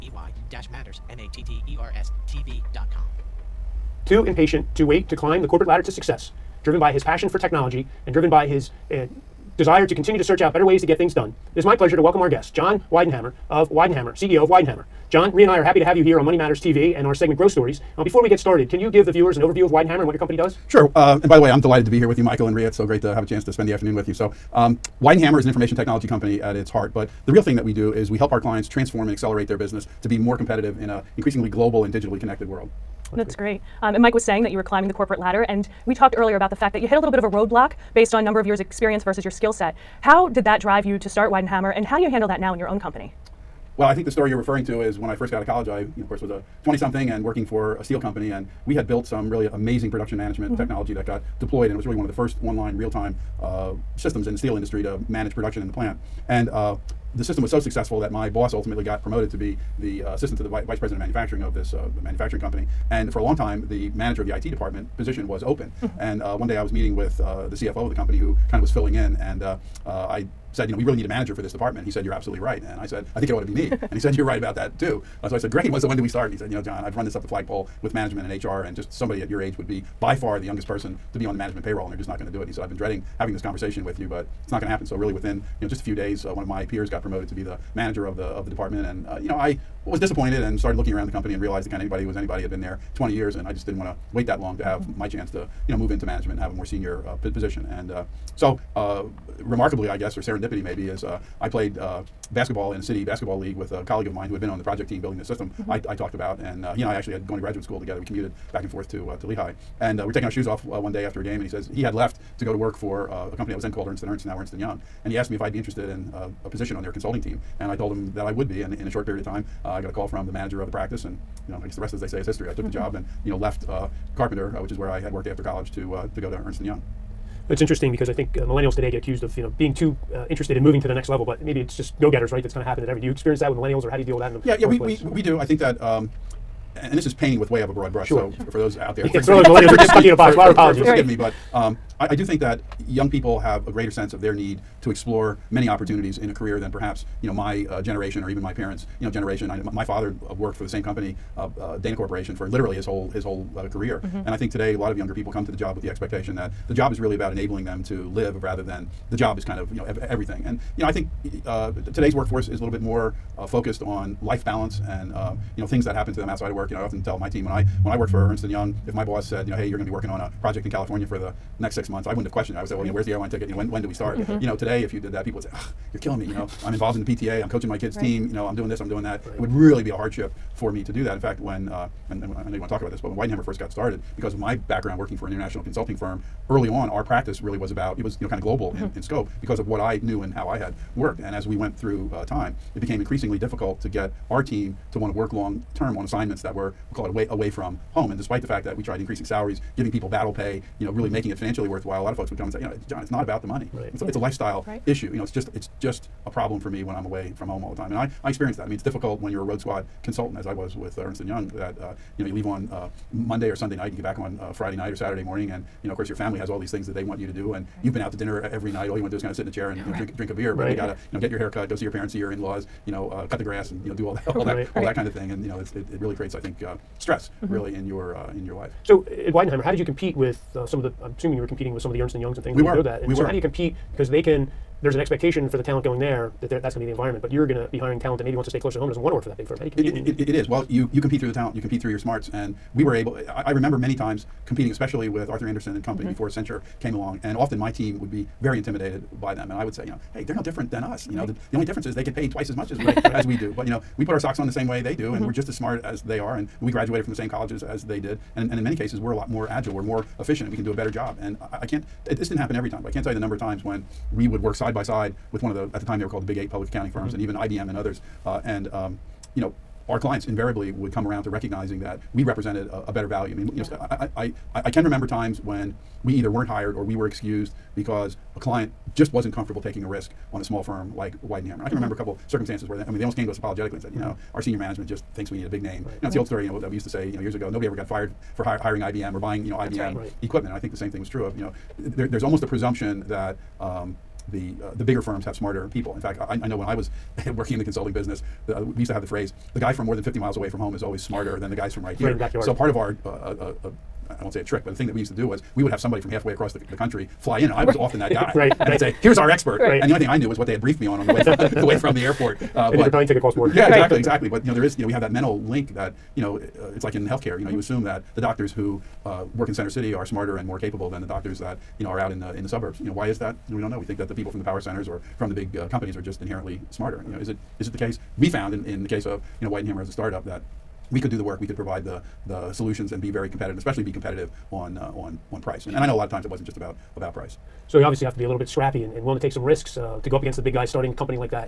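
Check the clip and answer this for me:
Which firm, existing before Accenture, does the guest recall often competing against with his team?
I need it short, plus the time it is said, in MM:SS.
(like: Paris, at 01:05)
Arthur Andersen, at 04:05.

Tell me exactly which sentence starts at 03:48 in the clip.
So, at Weidenhammer, how did you compete with uh, some of the.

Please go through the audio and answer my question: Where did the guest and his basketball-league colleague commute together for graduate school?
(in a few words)
Lehigh.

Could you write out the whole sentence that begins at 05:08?
they'd say, "Here's our expert." Right.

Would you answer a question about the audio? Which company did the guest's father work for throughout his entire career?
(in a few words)
Dana Corporation.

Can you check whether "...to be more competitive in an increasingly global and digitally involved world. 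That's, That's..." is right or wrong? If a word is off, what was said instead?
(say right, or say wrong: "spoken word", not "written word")
wrong: "connected", not "involved".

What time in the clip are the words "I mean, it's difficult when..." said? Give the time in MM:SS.
03:28.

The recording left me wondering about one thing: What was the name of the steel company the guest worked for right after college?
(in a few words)
Carpenter.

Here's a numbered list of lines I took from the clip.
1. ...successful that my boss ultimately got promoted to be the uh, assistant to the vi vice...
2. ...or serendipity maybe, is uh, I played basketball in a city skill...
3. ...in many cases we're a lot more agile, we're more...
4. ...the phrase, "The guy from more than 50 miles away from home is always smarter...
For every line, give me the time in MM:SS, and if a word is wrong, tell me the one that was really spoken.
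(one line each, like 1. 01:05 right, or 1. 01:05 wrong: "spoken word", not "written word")
1. 00:57 right
2. 01:40 wrong: "basketball", not "skill"
3. 04:18 right
4. 04:59 right.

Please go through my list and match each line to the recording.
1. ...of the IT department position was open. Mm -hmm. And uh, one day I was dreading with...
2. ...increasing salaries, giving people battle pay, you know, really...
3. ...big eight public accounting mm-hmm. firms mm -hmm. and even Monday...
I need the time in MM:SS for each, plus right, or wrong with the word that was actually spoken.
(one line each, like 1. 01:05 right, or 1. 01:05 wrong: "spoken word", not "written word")
1. 01:04 wrong: "meeting", not "dreading"
2. 03:18 right
3. 04:26 wrong: "IBM", not "Monday".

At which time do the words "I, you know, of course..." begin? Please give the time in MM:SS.
00:45.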